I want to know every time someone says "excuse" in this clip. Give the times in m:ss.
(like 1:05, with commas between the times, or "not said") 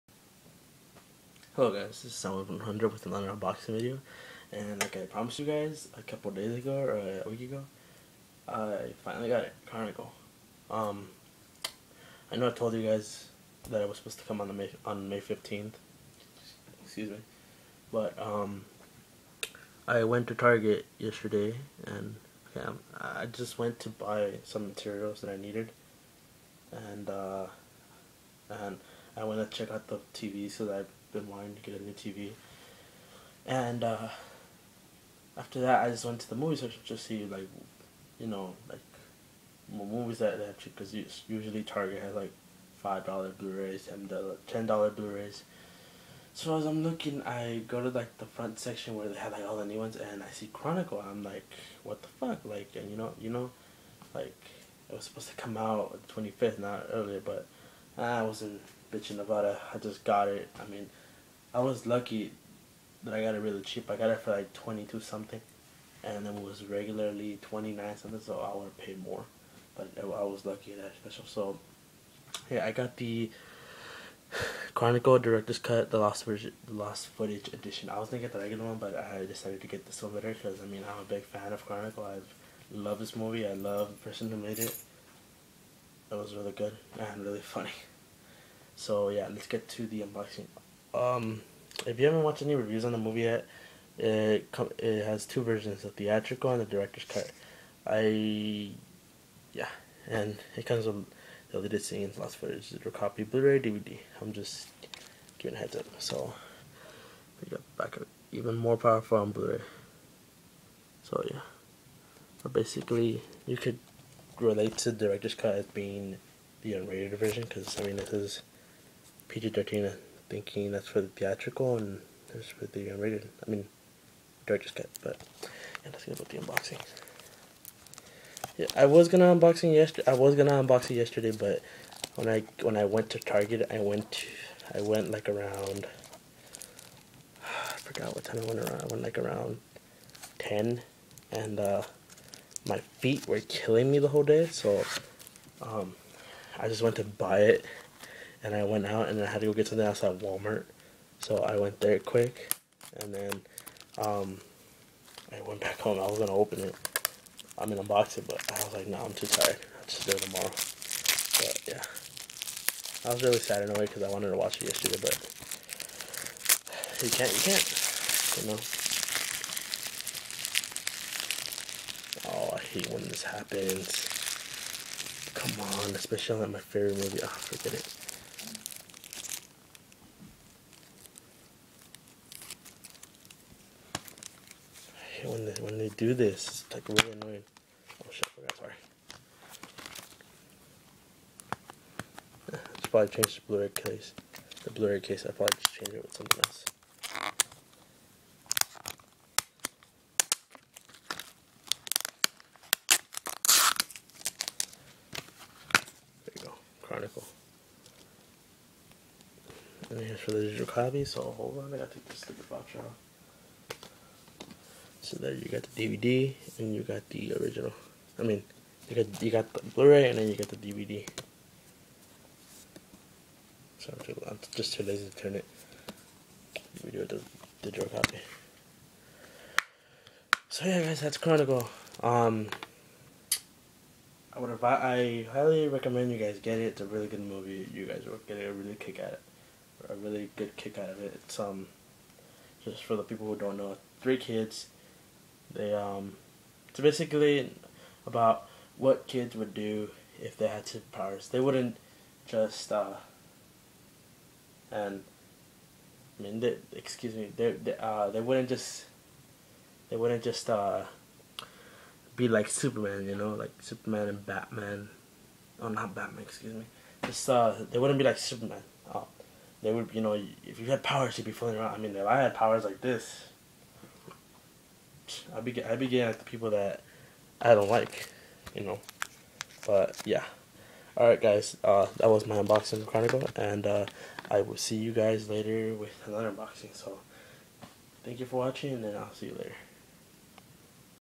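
0:16, 4:16, 4:26.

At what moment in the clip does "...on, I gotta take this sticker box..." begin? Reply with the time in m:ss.
3:31.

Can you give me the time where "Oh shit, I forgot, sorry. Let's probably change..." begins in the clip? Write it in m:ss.
3:08.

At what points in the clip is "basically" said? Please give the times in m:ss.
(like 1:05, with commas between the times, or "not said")
1:52, 4:06.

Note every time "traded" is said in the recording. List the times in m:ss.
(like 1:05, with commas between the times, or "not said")
not said.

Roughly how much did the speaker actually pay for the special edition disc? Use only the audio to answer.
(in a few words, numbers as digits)
22.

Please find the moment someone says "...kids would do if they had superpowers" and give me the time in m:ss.
4:09.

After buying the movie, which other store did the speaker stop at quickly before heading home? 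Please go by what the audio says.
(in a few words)
Walmart.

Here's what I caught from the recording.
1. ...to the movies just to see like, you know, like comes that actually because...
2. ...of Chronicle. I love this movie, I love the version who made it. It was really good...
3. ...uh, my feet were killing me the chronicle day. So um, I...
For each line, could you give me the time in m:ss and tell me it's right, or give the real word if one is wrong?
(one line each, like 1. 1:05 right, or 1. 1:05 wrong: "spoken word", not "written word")
1. 0:36 wrong: "movies", not "comes"
2. 1:21 wrong: "person", not "version"
3. 2:21 wrong: "whole", not "chronicle".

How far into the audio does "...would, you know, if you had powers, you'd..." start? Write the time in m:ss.
4:29.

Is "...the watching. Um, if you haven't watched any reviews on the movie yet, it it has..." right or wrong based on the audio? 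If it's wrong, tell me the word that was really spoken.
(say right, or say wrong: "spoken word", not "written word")
wrong: "unboxing", not "watching".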